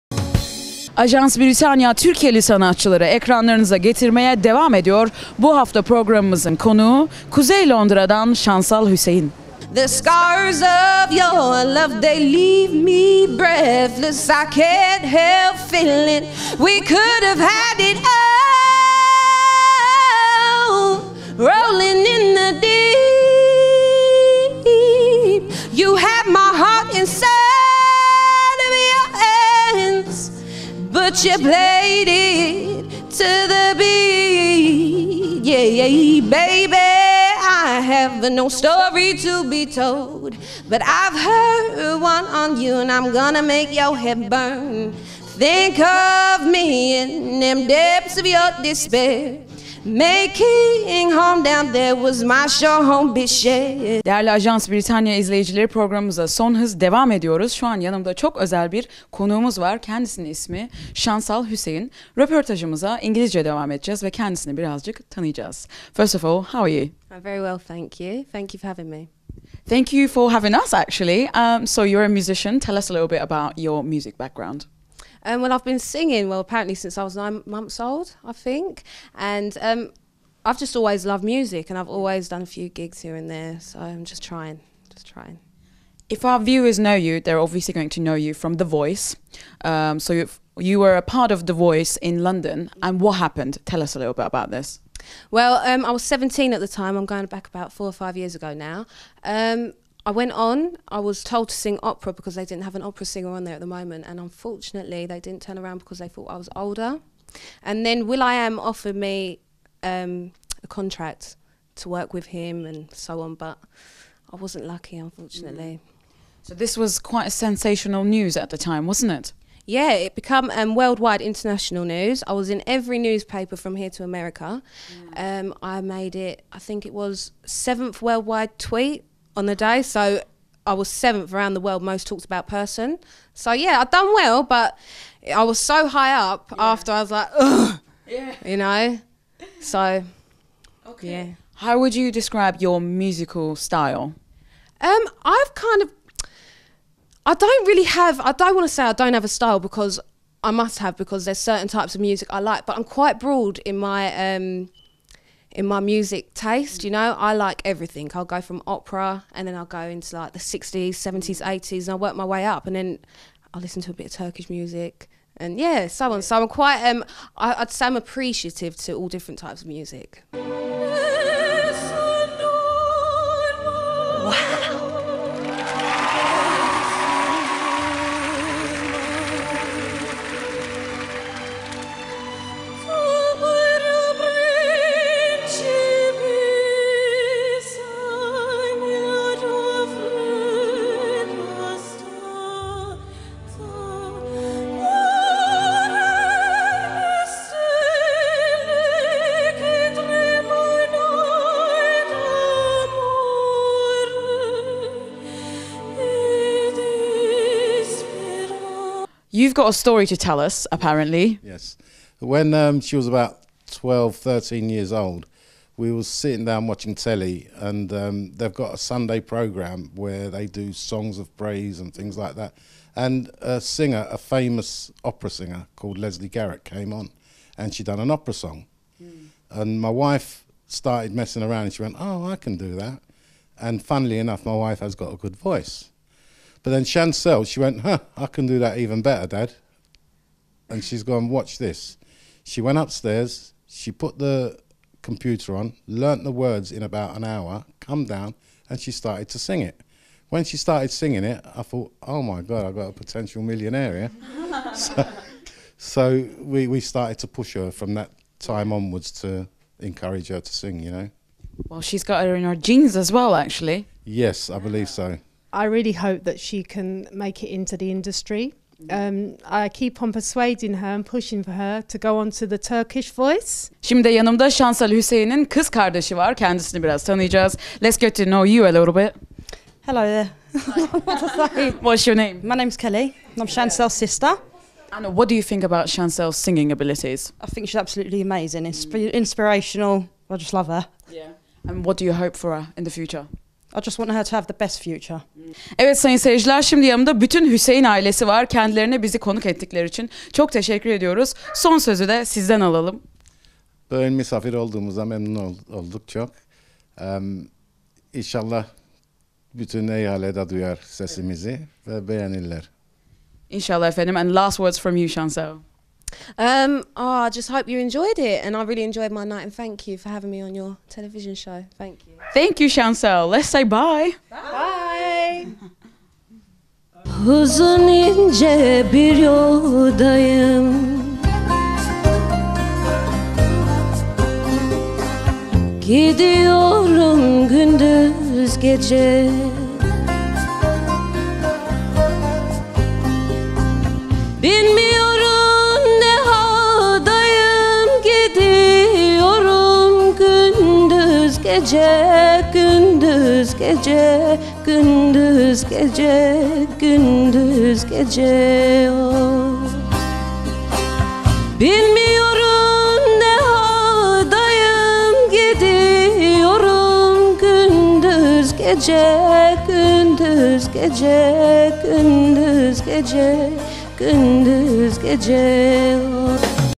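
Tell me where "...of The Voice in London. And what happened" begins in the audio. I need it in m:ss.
1:31.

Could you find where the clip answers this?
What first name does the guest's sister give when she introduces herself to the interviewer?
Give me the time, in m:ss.
4:42.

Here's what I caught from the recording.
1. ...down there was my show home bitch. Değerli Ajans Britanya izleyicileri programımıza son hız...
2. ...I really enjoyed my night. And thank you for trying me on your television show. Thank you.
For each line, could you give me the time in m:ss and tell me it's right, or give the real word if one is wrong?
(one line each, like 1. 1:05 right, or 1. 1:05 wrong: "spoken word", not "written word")
1. 0:51 right
2. 5:18 wrong: "having", not "trying".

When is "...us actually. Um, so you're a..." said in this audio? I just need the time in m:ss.
1:10.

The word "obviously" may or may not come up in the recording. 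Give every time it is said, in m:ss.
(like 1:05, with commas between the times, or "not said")
1:27.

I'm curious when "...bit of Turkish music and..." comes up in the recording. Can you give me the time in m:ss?
2:43.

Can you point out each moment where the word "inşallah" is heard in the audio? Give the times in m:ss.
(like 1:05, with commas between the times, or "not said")
5:08, 5:13.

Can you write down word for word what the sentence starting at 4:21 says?
Well, she's got her in her genes as well, actually.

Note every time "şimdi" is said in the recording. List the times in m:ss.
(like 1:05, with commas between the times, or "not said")
4:33, 4:56.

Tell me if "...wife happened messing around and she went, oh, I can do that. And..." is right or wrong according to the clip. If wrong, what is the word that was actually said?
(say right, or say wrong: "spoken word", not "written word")
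wrong: "started", not "happened".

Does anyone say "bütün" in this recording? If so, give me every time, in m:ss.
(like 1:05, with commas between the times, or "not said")
4:57, 5:09.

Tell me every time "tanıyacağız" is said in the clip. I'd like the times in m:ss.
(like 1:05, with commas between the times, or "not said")
1:05, 4:37.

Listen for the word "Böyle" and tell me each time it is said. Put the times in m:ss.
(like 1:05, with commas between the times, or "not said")
5:03.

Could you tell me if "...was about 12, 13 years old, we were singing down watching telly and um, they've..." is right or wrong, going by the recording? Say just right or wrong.
wrong.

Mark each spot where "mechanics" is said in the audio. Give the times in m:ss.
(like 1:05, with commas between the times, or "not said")
not said.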